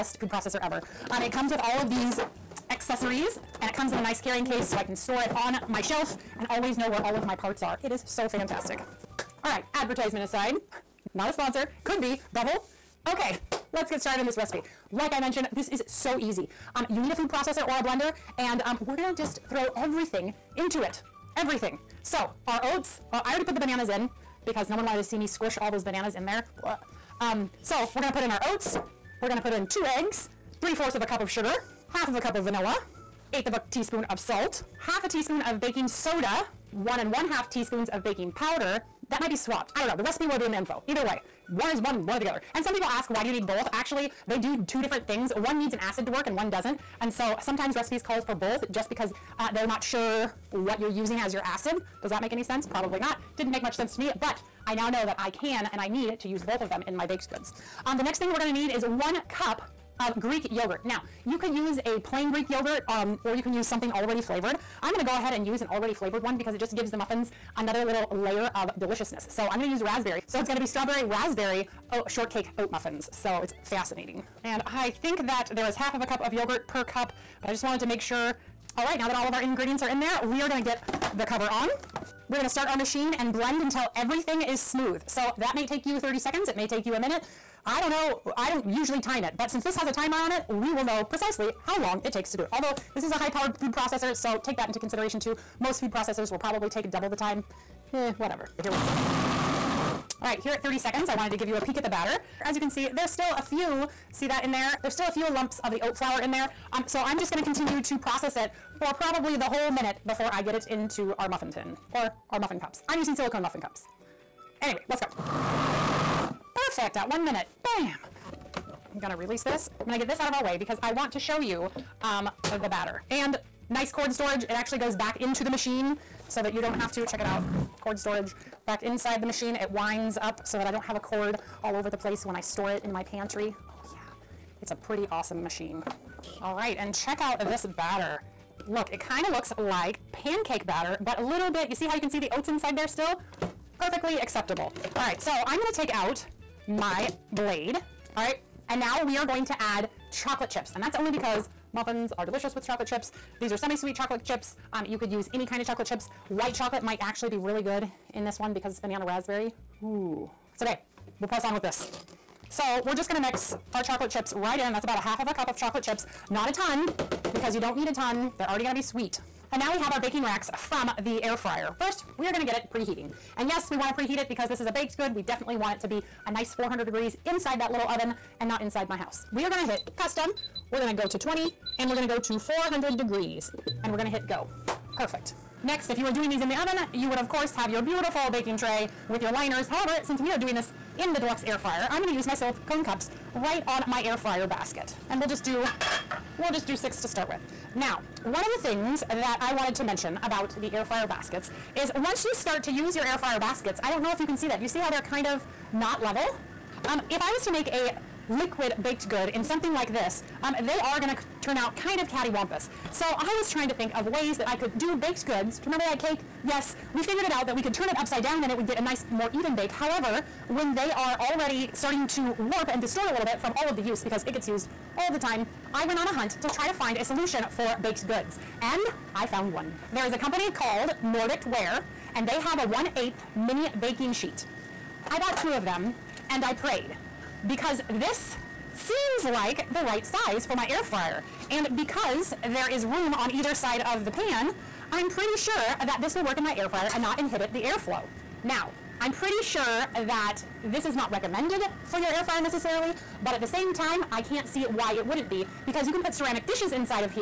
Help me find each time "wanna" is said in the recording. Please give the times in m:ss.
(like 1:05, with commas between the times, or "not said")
2:53.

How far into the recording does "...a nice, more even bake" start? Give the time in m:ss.
3:38.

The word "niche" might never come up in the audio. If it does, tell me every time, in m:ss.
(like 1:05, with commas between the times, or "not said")
not said.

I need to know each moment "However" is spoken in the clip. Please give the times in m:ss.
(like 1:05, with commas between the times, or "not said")
3:09, 3:39.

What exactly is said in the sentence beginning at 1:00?
Now, you could use a plain Greek yogurt um, or you can use something already flavored.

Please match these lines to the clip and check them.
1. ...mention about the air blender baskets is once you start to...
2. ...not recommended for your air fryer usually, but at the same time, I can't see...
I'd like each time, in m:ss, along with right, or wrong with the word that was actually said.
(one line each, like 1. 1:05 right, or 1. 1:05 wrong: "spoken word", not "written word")
1. 3:19 wrong: "fryer", not "blender"
2. 4:10 wrong: "necessarily", not "usually".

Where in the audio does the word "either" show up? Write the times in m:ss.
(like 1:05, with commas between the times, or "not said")
0:40, 4:03.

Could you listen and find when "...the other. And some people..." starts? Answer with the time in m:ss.
0:42.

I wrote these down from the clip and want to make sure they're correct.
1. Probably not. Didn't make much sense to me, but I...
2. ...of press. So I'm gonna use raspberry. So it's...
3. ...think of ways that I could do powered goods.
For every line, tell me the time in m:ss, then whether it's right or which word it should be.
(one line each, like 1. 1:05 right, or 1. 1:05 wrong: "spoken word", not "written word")
1. 0:52 right
2. 1:08 wrong: "deliciousness", not "press"
3. 3:33 wrong: "baked", not "powered".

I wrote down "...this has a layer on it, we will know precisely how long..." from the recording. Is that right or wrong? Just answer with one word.
wrong.